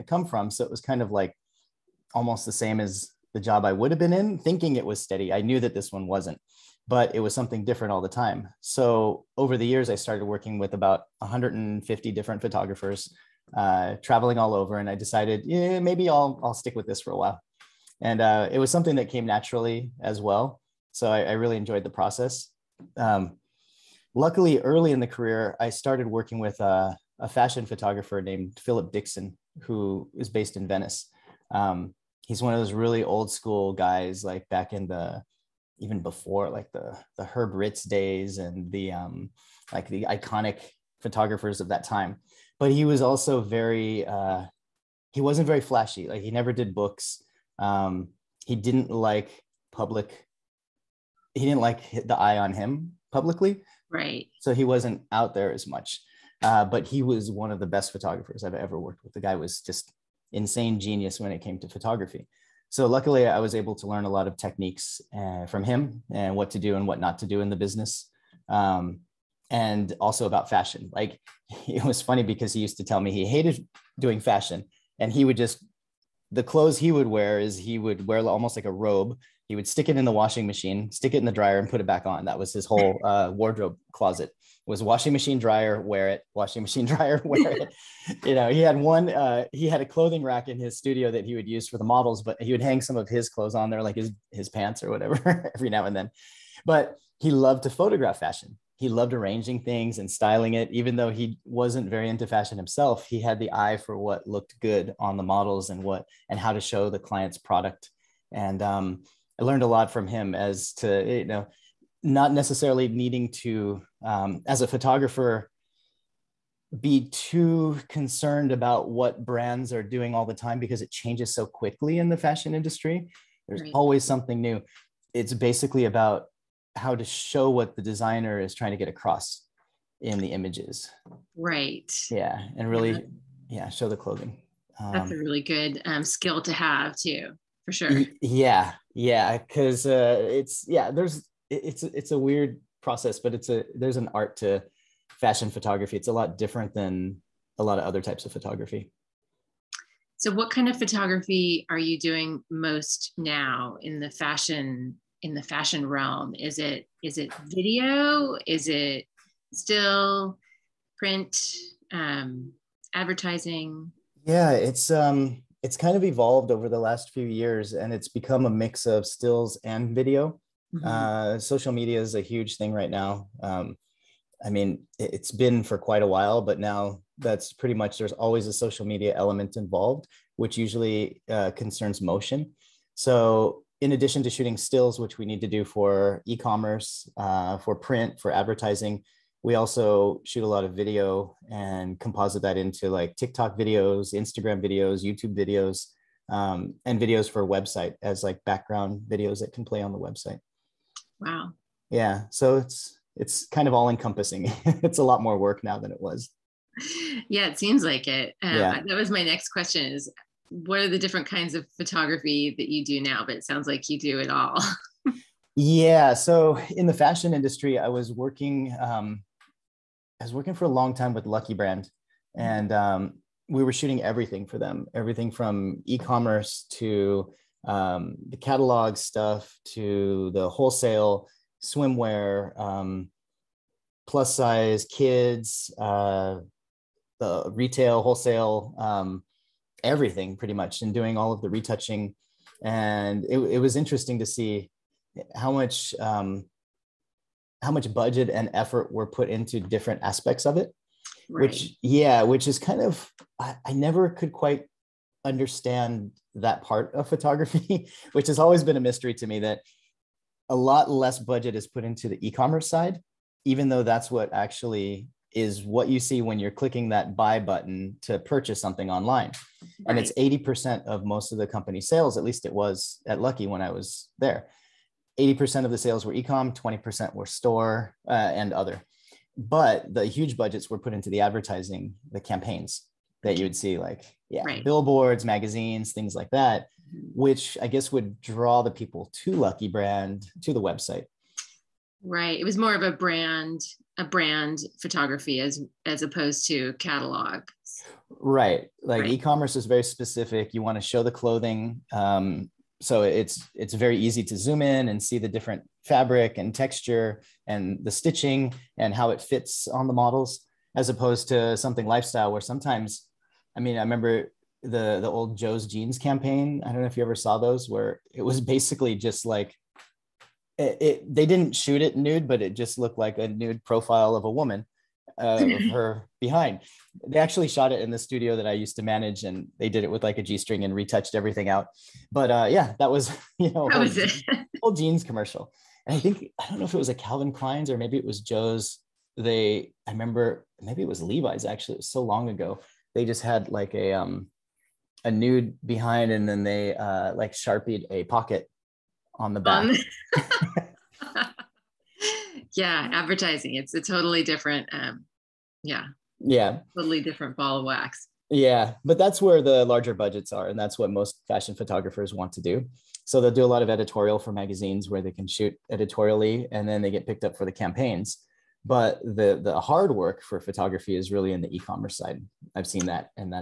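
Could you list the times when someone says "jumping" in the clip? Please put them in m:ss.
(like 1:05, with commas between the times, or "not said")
not said.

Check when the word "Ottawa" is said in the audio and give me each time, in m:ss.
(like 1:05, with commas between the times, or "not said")
not said.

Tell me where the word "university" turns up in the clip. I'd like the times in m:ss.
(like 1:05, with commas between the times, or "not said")
not said.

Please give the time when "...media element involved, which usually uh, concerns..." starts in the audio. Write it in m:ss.
2:58.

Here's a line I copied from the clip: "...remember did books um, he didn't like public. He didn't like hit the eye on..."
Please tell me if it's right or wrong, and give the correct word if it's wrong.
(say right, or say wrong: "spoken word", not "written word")
wrong: "never", not "remember".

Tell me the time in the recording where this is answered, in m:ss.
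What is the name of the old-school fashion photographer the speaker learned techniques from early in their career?
0:28.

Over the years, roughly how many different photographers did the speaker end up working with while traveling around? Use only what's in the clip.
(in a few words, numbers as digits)
150.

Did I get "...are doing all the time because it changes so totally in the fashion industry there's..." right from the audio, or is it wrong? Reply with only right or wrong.
wrong.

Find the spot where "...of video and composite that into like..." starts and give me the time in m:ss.
3:10.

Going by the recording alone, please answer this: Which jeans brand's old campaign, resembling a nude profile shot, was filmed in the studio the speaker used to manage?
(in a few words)
Joe's Jeans.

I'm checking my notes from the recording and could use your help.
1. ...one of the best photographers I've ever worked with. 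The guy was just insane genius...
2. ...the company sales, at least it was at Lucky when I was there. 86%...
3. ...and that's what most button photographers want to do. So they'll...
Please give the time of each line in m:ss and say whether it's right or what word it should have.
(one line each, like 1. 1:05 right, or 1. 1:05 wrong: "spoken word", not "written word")
1. 0:57 right
2. 4:31 wrong: "80", not "86"
3. 6:00 wrong: "fashion", not "button".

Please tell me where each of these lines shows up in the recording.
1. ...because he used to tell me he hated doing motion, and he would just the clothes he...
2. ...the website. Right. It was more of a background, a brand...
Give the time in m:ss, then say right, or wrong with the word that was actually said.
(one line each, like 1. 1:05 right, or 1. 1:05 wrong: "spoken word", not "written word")
1. 1:12 wrong: "fashion", not "motion"
2. 4:50 wrong: "brand", not "background".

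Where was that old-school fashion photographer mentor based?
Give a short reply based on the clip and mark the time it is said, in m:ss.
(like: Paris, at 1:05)
Venice, at 0:30.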